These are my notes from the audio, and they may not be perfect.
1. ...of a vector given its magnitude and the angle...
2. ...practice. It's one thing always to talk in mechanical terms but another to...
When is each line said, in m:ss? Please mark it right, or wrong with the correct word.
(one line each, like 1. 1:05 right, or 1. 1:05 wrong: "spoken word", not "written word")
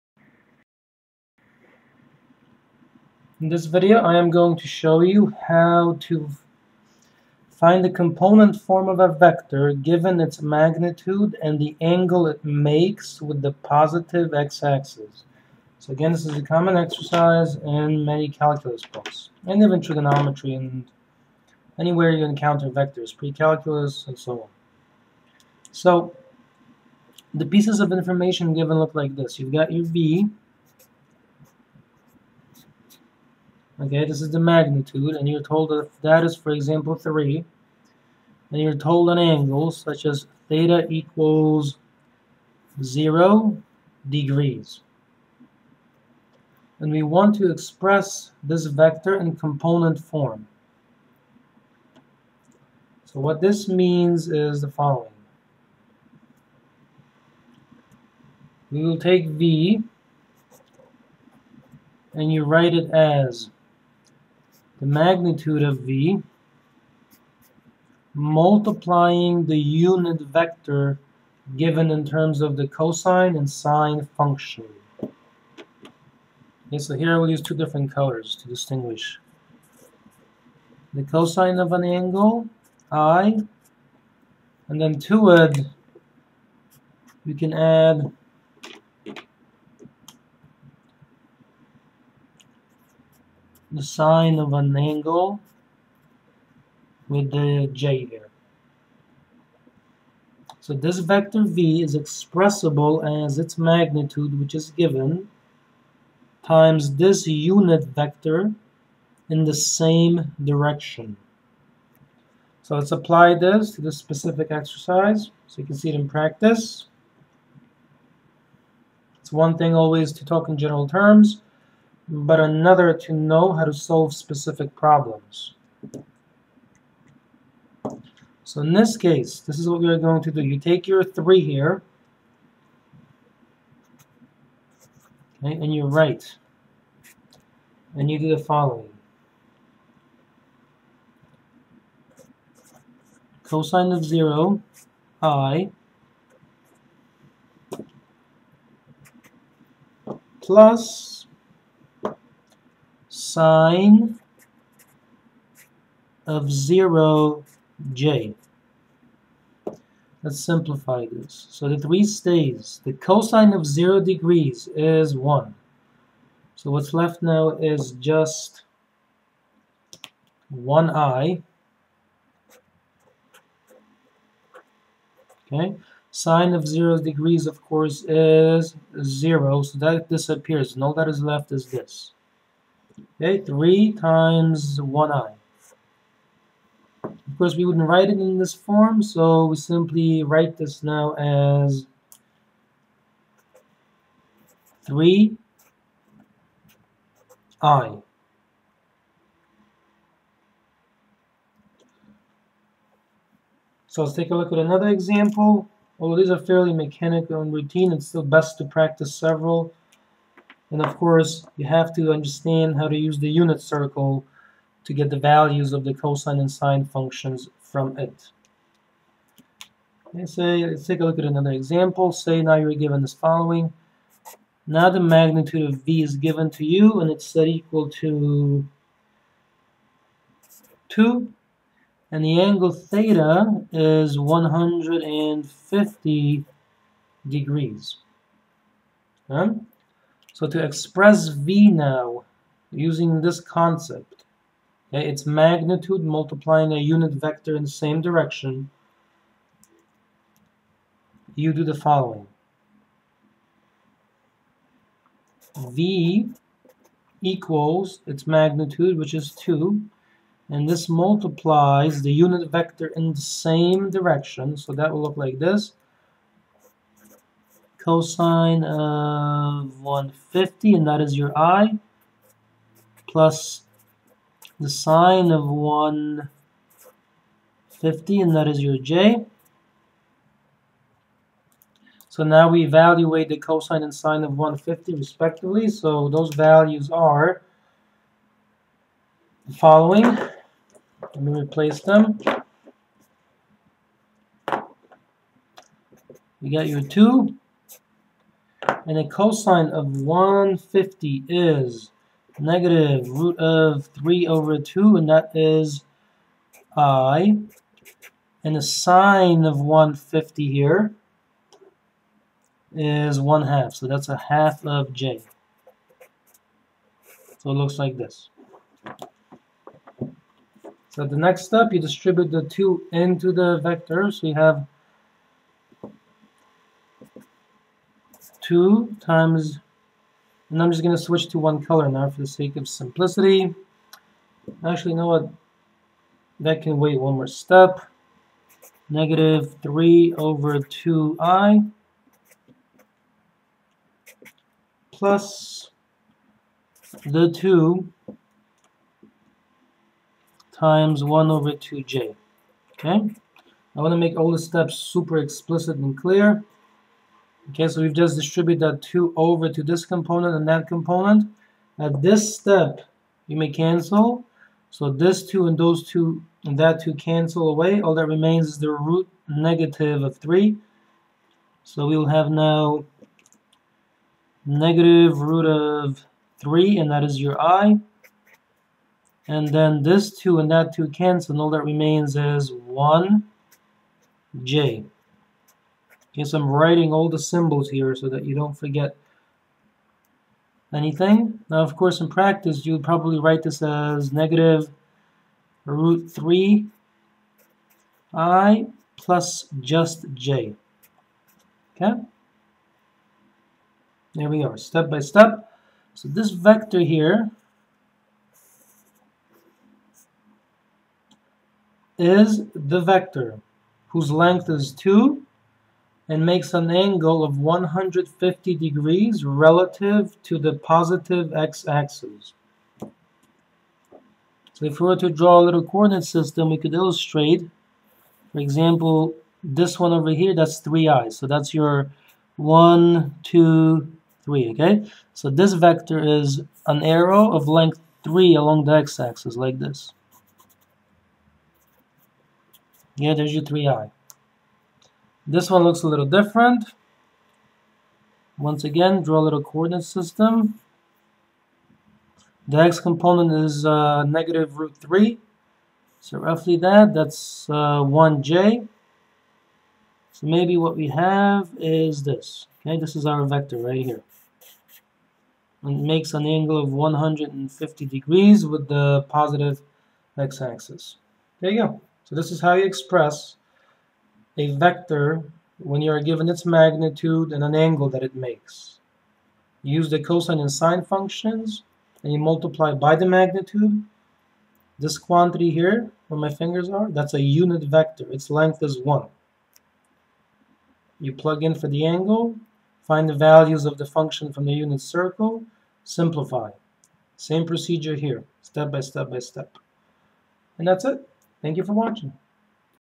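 1. 0:08 right
2. 1:56 wrong: "general", not "mechanical".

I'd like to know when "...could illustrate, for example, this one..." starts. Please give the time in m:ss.
7:06.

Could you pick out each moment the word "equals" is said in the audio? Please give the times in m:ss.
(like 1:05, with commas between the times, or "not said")
0:40, 3:47, 4:17.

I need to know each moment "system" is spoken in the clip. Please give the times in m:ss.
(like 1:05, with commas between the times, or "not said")
7:06, 7:29.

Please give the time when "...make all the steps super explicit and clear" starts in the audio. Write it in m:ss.
5:53.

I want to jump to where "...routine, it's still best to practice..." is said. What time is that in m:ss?
3:27.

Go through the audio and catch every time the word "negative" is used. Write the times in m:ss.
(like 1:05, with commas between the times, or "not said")
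5:02, 5:38, 6:09, 6:14, 6:34, 7:34.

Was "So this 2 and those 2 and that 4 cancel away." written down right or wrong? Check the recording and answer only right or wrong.
wrong.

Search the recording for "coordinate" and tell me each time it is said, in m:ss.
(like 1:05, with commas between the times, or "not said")
7:05, 7:29.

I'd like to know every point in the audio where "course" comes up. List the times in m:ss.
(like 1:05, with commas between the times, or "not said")
2:57, 3:07, 3:30, 6:31.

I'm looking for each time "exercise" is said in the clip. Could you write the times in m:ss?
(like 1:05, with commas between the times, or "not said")
0:16, 1:54.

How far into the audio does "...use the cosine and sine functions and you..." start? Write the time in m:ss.
7:59.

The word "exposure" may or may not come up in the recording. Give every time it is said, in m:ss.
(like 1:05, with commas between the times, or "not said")
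not said.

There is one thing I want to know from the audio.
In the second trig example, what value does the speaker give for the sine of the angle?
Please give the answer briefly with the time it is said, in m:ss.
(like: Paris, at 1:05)
1/2, at 5:13.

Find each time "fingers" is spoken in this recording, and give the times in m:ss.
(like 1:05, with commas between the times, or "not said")
8:06.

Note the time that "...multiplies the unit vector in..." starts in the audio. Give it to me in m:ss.
4:20.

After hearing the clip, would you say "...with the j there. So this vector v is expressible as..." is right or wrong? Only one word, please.
right.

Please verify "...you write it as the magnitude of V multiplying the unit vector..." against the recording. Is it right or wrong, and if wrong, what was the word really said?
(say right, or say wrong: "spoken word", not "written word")
right.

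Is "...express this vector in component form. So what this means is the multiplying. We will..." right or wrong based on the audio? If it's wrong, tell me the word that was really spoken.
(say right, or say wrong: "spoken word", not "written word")
wrong: "following", not "multiplying".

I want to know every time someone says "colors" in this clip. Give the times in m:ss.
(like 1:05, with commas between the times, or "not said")
1:17, 5:31.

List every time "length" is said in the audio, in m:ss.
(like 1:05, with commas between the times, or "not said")
6:54, 7:17, 8:08.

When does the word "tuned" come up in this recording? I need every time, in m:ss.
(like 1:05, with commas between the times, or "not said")
not said.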